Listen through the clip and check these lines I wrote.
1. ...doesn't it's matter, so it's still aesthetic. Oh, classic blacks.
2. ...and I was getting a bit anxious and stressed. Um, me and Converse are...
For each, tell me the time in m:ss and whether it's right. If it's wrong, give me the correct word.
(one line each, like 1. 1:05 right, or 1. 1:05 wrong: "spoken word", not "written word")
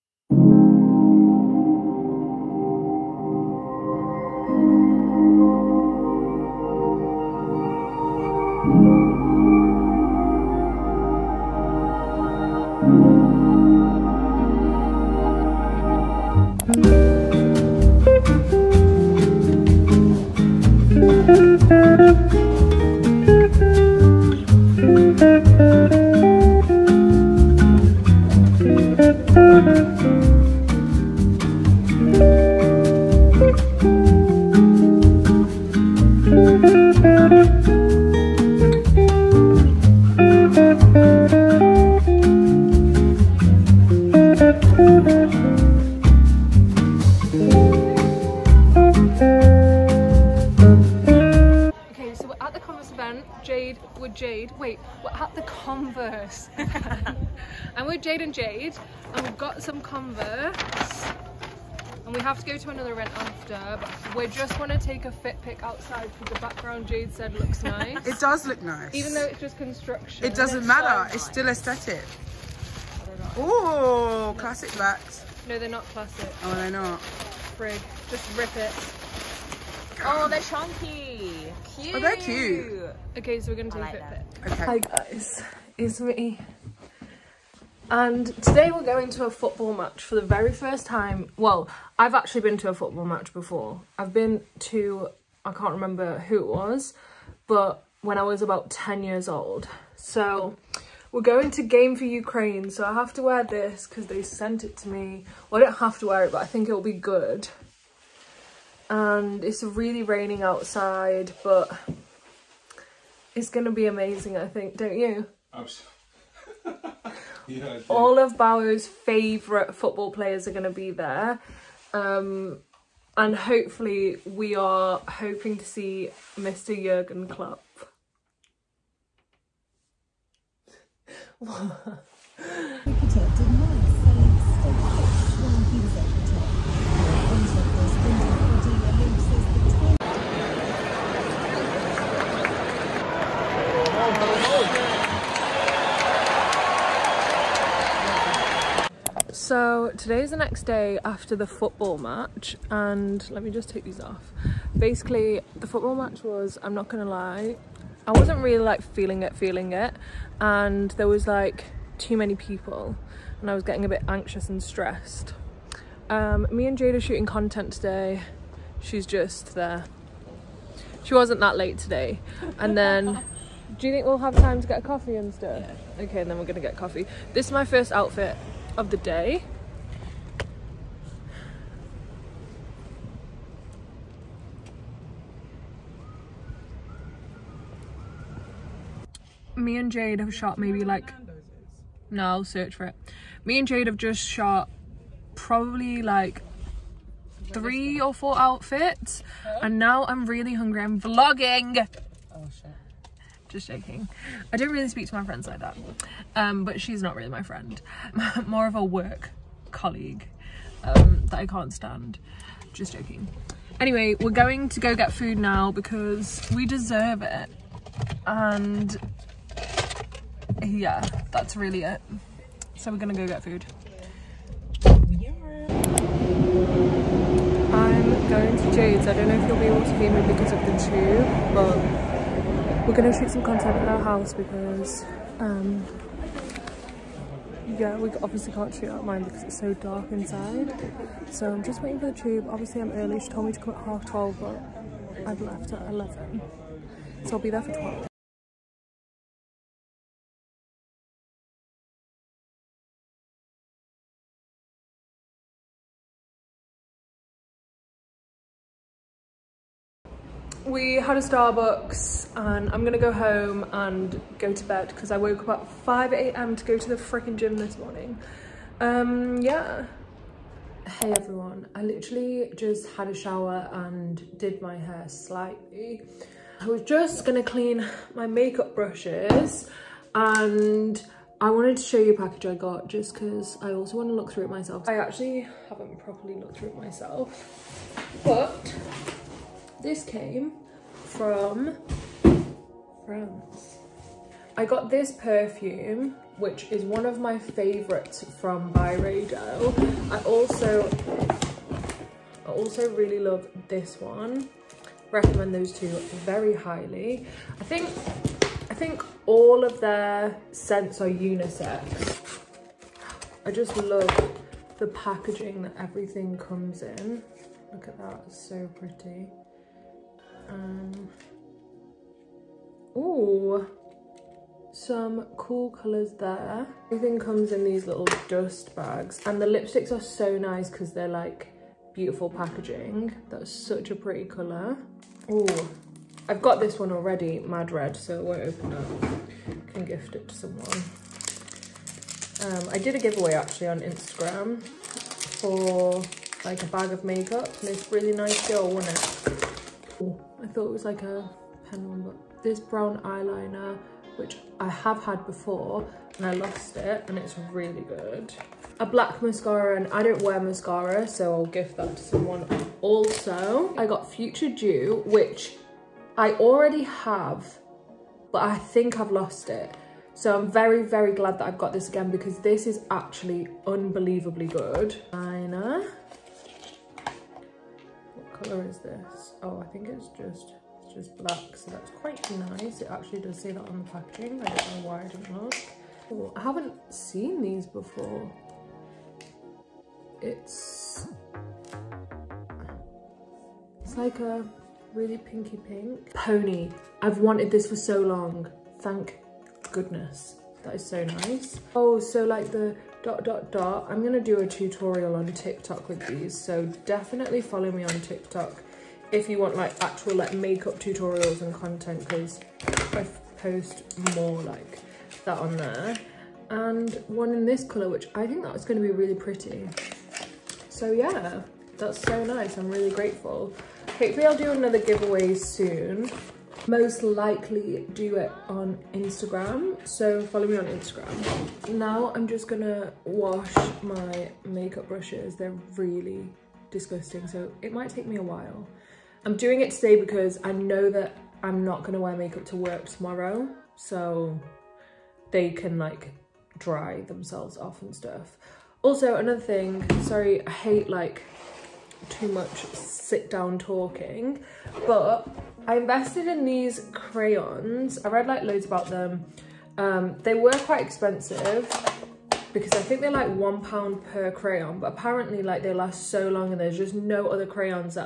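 1. 1:10 right
2. 2:43 wrong: "Jade", not "Converse".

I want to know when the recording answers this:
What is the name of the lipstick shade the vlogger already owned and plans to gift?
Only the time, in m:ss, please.
5:37.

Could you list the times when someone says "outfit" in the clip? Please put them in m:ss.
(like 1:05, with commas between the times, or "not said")
2:57, 3:18.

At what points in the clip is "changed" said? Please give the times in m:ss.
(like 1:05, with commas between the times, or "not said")
not said.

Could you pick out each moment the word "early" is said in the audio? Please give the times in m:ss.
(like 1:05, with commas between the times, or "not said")
4:02.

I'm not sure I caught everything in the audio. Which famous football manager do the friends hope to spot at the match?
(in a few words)
Jurgen Klopp.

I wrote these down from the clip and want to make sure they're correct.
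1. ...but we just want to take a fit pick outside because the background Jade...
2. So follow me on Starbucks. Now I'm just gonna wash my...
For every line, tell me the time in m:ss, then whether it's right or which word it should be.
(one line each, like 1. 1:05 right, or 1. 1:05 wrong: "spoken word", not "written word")
1. 1:03 right
2. 7:09 wrong: "Instagram", not "Starbucks".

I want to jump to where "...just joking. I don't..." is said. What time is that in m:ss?
3:23.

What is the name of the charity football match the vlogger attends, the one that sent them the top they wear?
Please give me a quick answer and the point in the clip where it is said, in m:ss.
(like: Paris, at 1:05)
Game for Ukraine, at 1:41.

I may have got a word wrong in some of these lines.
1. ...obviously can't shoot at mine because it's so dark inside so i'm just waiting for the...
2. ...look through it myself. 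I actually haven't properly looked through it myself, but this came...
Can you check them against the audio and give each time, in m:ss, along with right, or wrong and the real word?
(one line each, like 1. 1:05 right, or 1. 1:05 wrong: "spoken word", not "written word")
1. 3:58 right
2. 4:44 right.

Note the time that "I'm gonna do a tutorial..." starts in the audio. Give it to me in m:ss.
6:43.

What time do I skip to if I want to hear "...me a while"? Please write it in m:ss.
7:18.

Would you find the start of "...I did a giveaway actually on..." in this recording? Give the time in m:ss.
5:42.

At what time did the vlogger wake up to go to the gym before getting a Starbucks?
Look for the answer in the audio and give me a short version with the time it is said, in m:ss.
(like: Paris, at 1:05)
5 a.m., at 4:25.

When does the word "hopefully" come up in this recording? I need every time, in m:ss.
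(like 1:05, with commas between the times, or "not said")
2:03, 7:03.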